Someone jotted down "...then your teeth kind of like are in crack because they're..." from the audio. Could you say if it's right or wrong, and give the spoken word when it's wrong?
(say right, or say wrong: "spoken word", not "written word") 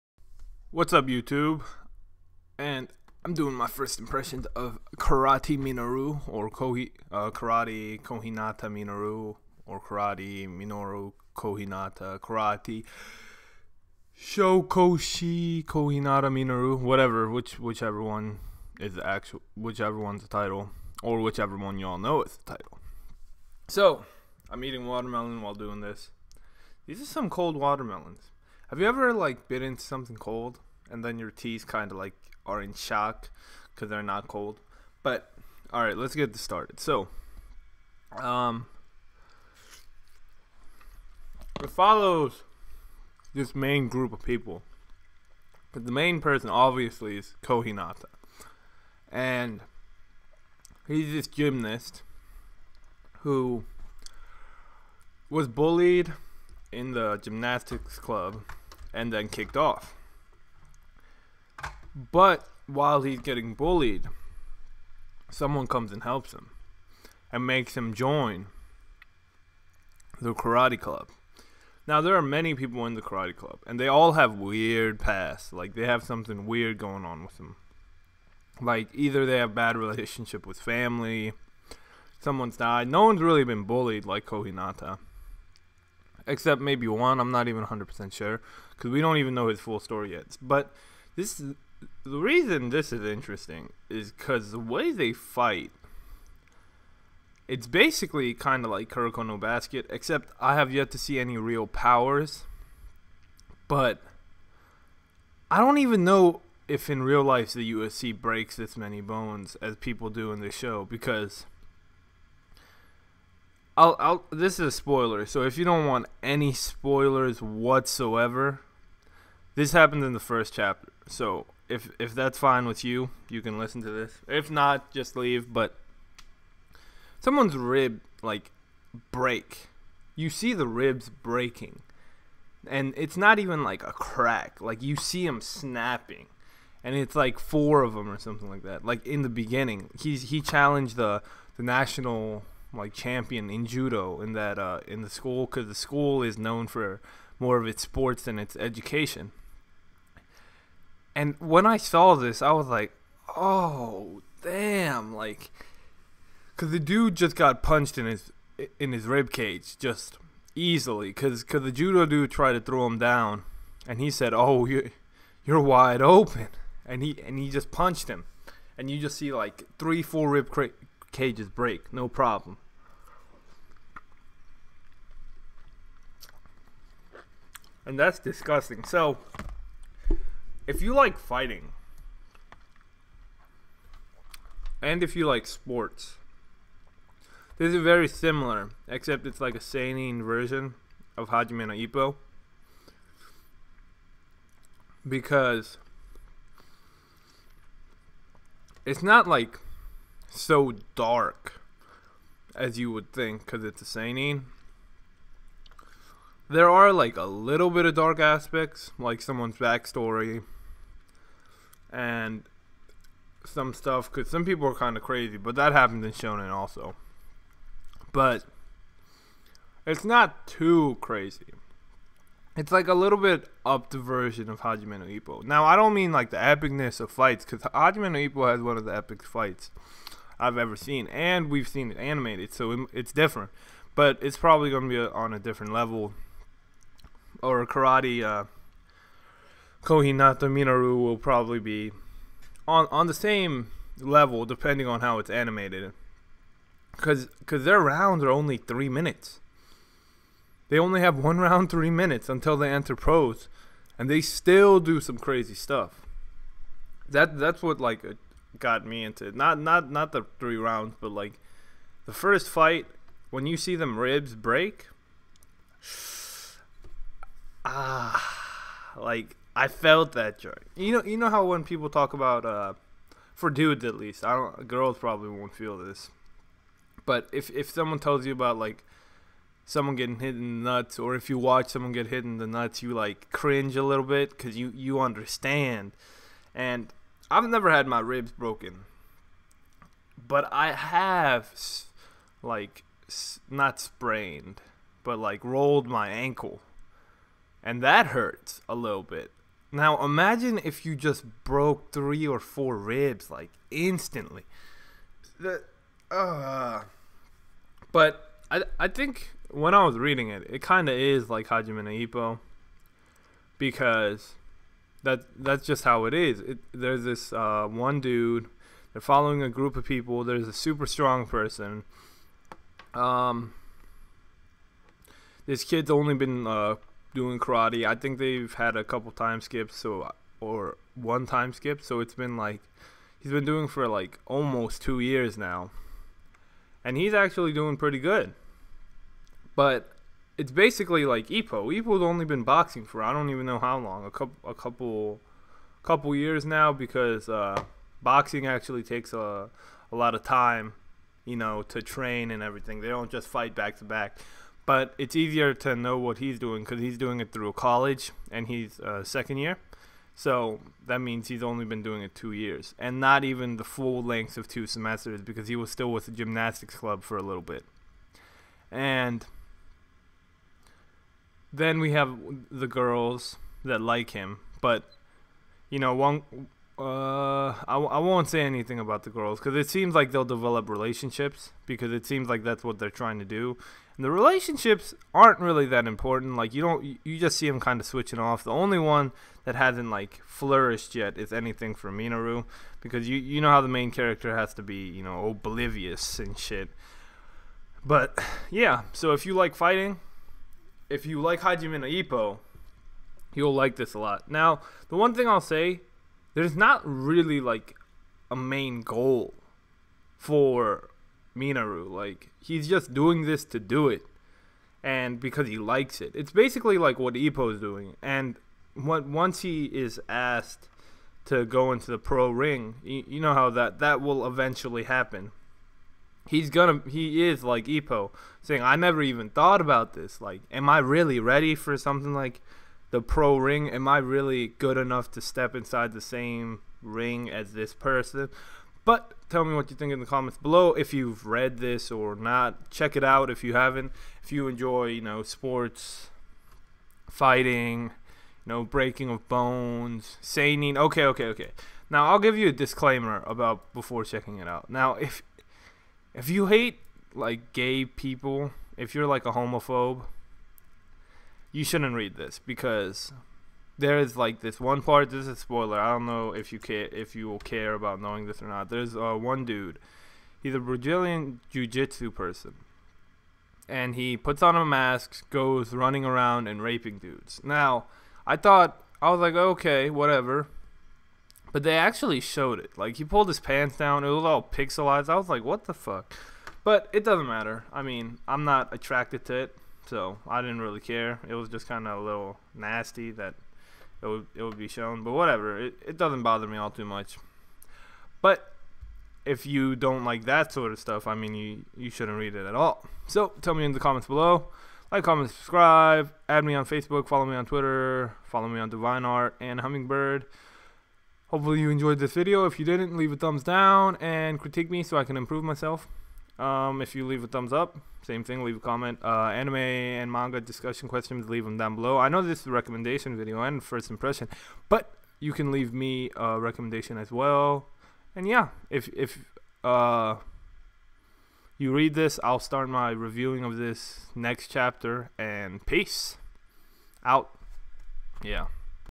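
wrong: "shock", not "crack".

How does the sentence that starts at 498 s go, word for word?
But if you don't like that sort of stuff, I mean, you you shouldn't read it at all.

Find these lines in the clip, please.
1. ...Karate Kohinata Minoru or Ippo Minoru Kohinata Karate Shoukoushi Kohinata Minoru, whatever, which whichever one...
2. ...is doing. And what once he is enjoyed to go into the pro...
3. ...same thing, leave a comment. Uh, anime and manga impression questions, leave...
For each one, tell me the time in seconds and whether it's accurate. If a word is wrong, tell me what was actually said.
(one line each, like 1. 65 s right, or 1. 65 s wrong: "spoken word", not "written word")
1. 7 s wrong: "Karate", not "Ippo"
2. 417 s wrong: "asked", not "enjoyed"
3. 518 s wrong: "discussion", not "impression".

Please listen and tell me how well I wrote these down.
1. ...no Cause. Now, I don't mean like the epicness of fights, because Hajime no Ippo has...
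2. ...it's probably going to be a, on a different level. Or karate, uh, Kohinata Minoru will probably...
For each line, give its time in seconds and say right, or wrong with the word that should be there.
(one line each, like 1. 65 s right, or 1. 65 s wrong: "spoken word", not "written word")
1. 224 s wrong: "Ippo", not "Cause"
2. 234 s right.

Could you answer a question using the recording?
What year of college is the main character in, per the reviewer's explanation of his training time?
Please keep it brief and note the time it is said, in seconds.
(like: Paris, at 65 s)
Second year, at 359 s.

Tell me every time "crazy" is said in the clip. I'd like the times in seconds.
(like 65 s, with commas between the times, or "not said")
215 s, 220 s, 255 s.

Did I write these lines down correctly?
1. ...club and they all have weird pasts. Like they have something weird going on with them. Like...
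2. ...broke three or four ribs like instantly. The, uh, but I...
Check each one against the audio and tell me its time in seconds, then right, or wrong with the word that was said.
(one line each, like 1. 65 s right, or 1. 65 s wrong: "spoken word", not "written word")
1. 73 s right
2. 301 s right.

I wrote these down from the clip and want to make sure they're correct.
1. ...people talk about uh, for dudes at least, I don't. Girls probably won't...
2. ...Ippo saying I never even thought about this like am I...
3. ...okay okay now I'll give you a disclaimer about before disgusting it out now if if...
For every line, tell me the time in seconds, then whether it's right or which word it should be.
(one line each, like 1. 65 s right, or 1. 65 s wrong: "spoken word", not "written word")
1. 271 s right
2. 427 s right
3. 451 s wrong: "checking", not "disgusting".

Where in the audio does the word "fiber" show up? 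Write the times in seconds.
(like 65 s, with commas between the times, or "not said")
not said.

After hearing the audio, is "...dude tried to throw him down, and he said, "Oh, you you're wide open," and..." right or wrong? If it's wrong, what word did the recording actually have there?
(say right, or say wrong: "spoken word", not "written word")
right.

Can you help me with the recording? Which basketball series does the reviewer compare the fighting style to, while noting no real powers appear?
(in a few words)
Kuroko no Basket.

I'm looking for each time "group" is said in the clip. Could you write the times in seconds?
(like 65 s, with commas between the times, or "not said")
43 s, 319 s.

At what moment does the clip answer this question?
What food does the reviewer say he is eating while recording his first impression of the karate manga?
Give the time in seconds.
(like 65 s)
24 s.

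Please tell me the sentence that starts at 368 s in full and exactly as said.
And then we have the girls that like him, but you know, one.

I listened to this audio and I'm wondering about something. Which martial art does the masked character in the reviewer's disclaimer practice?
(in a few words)
Brazilian jiu-jitsu.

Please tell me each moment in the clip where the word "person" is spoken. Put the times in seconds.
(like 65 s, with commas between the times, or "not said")
46 s, 321 s, 437 s, 472 s.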